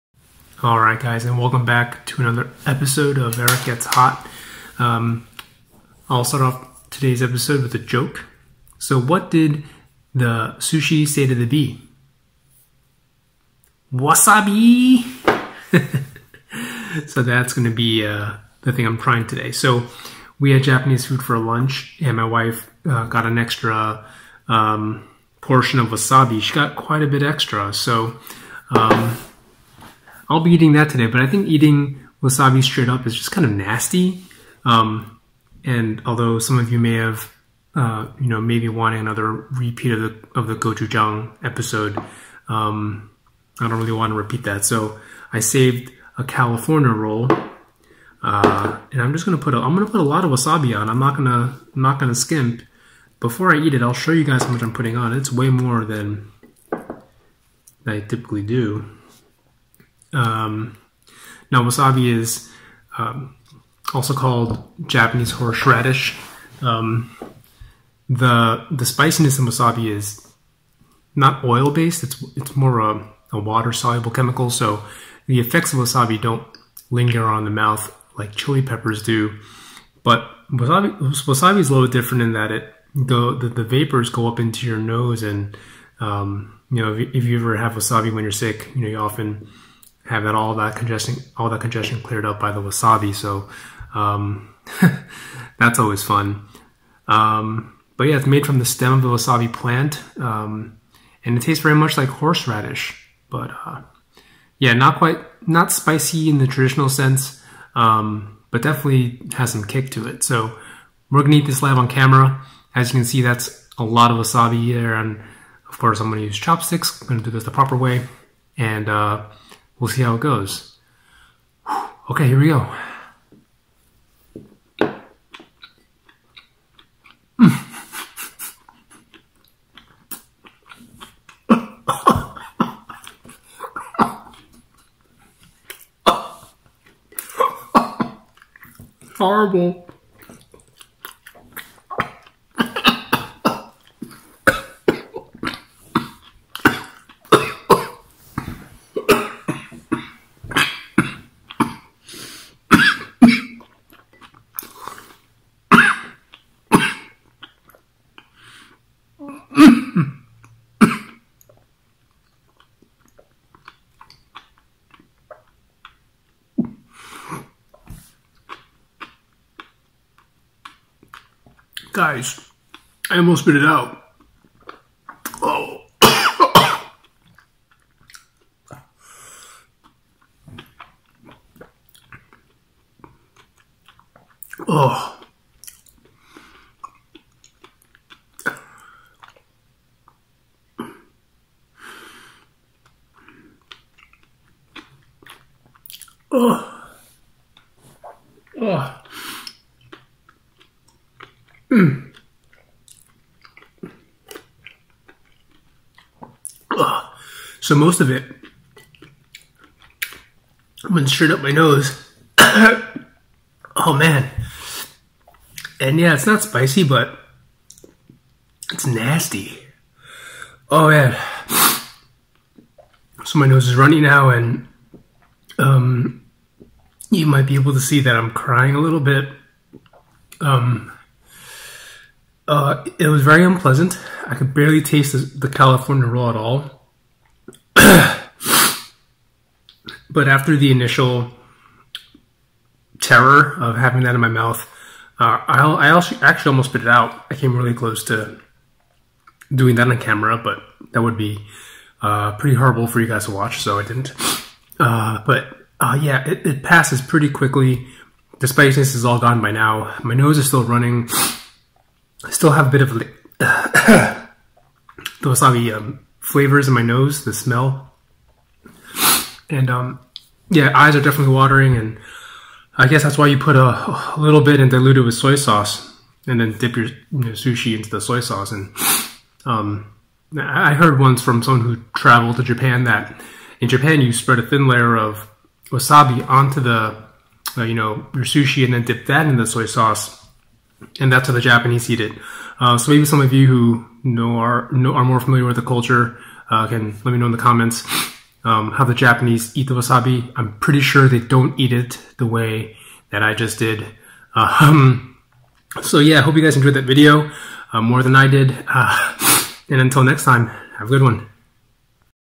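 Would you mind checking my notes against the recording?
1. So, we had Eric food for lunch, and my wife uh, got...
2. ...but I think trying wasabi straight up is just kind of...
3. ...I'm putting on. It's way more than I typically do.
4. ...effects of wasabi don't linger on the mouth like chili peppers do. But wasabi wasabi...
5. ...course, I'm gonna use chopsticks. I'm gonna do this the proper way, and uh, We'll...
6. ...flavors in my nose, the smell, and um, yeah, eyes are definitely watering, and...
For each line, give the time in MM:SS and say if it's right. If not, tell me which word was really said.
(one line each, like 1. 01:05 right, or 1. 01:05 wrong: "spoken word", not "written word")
1. 00:19 wrong: "Japanese", not "Eric"
2. 00:31 wrong: "eating", not "trying"
3. 00:54 right
4. 01:15 right
5. 01:55 right
6. 04:26 right.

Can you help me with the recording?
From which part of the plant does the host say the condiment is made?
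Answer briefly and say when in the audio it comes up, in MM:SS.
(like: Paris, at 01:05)
the stem, at 01:38.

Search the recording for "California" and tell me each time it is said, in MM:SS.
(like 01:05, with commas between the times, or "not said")
00:46, 03:55.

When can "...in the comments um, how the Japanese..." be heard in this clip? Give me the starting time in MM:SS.
04:57.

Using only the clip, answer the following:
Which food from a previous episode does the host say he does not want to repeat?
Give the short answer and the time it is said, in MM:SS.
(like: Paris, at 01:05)
gochujang, at 00:40.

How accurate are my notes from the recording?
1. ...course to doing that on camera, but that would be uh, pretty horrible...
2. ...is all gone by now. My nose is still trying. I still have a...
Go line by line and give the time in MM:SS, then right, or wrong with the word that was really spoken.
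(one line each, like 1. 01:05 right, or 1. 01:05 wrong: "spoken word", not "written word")
1. 04:07 wrong: "close", not "course"
2. 04:18 wrong: "running", not "trying".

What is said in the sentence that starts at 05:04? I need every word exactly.
Um, so yeah, hope you guys enjoyed that video uh, more than I did.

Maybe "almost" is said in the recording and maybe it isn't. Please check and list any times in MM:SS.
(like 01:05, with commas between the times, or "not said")
02:53, 04:06.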